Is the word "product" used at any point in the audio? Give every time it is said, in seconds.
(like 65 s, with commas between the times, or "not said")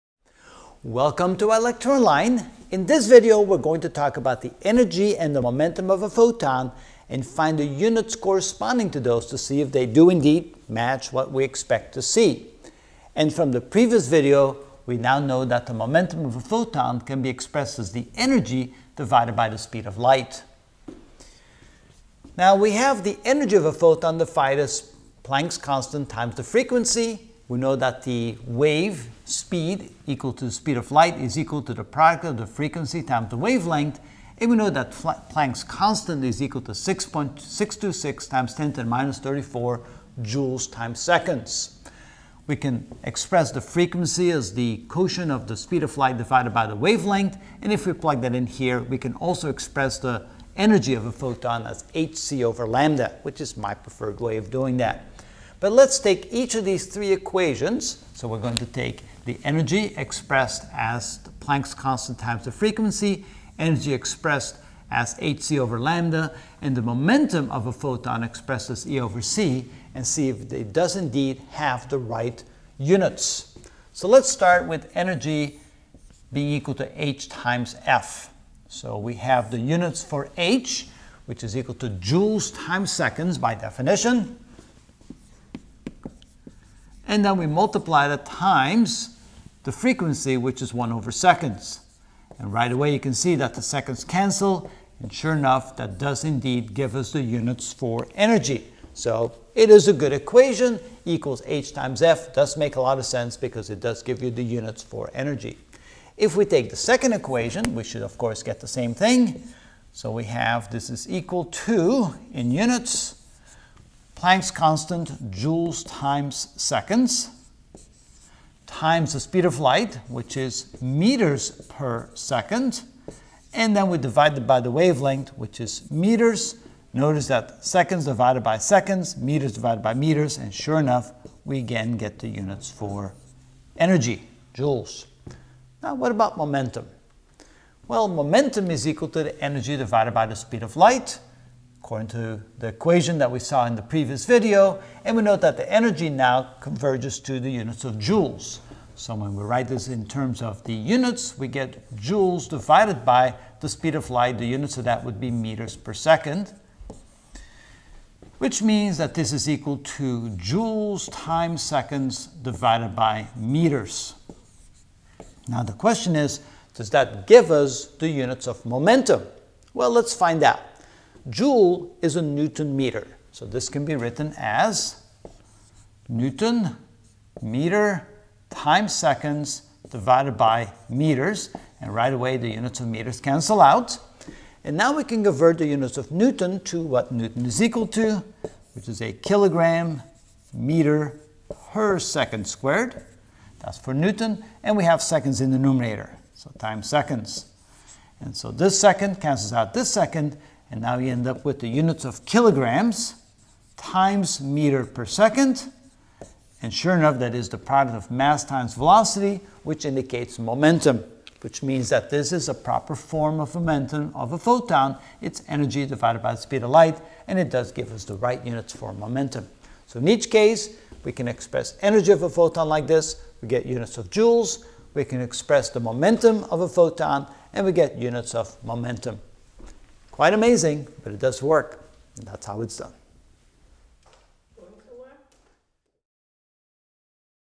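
31 s, 207 s.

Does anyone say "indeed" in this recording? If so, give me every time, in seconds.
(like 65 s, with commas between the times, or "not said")
10 s, 70 s, 96 s.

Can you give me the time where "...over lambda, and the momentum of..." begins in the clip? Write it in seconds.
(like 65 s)
65 s.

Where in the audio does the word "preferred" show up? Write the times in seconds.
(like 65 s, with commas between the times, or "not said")
53 s.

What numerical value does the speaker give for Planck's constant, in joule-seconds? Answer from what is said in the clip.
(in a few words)
6.626 x 10^-34.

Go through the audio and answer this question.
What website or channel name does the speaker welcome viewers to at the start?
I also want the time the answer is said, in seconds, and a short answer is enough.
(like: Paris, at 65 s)
ilectureonline, at 1 s.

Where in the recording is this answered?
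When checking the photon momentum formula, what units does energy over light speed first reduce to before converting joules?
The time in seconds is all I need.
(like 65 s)
160 s.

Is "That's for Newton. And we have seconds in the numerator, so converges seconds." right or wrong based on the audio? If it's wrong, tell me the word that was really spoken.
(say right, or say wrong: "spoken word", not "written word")
wrong: "times", not "converges".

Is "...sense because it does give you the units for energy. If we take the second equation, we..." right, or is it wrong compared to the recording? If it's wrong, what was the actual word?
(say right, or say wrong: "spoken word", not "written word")
right.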